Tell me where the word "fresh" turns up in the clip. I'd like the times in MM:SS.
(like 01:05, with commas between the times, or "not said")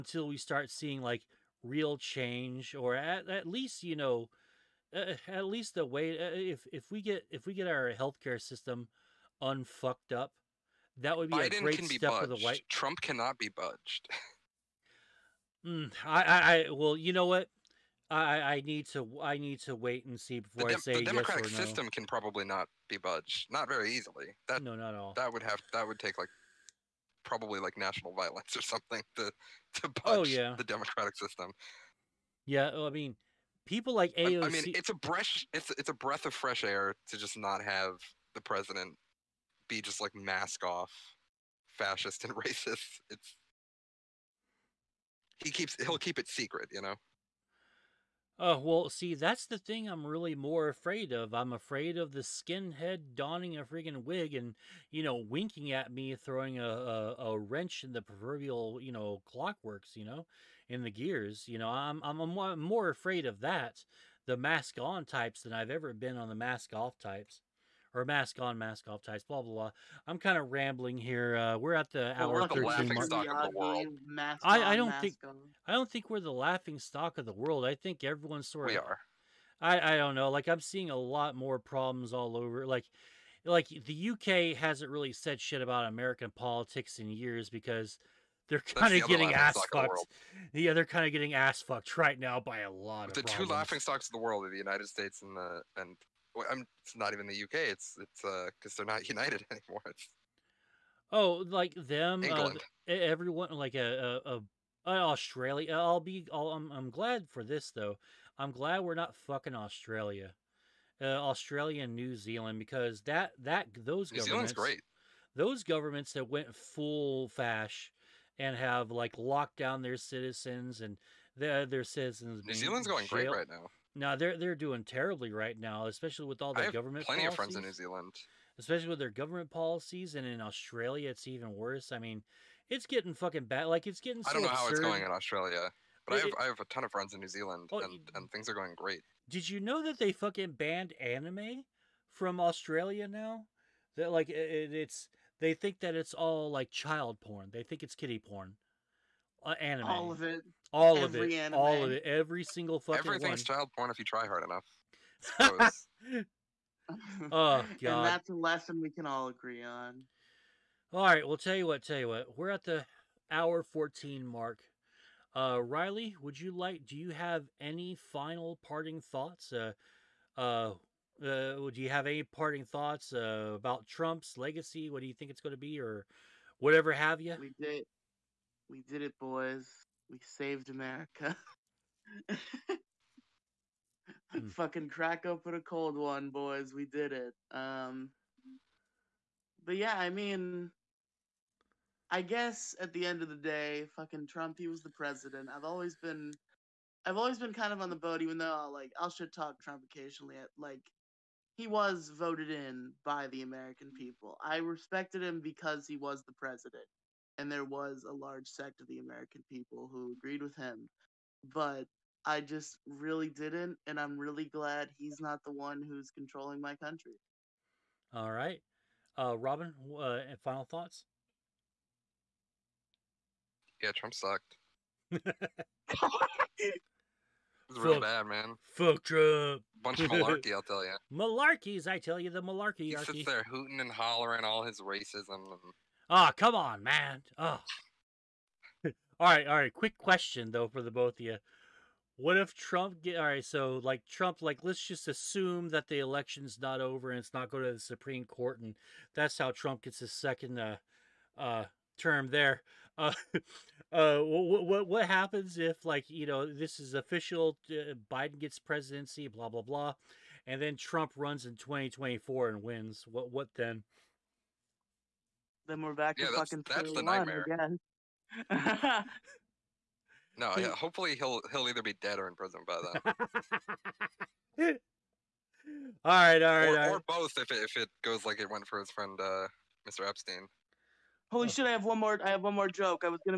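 00:36.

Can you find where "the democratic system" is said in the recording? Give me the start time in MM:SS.
00:30.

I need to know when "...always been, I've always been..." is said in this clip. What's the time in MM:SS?
03:15.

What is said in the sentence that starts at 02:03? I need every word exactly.
No, they're they're doing terribly right now, especially with all the government.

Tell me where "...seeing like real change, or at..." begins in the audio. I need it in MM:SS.
00:00.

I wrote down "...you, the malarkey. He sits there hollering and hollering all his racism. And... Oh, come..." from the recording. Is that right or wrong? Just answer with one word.
wrong.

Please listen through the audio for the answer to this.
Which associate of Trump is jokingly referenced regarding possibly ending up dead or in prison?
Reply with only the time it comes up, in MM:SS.
04:39.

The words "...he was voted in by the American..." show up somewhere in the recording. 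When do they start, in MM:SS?
03:21.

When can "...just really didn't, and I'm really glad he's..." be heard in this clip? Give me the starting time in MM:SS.
03:32.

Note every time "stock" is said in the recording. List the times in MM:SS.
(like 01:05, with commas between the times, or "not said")
01:16, 01:33.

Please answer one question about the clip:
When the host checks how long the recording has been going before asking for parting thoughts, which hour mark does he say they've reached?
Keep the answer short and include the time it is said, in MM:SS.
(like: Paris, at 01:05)
Hour 14, at 02:43.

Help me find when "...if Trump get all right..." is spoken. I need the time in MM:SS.
04:02.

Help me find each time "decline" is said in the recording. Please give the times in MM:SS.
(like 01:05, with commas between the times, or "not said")
not said.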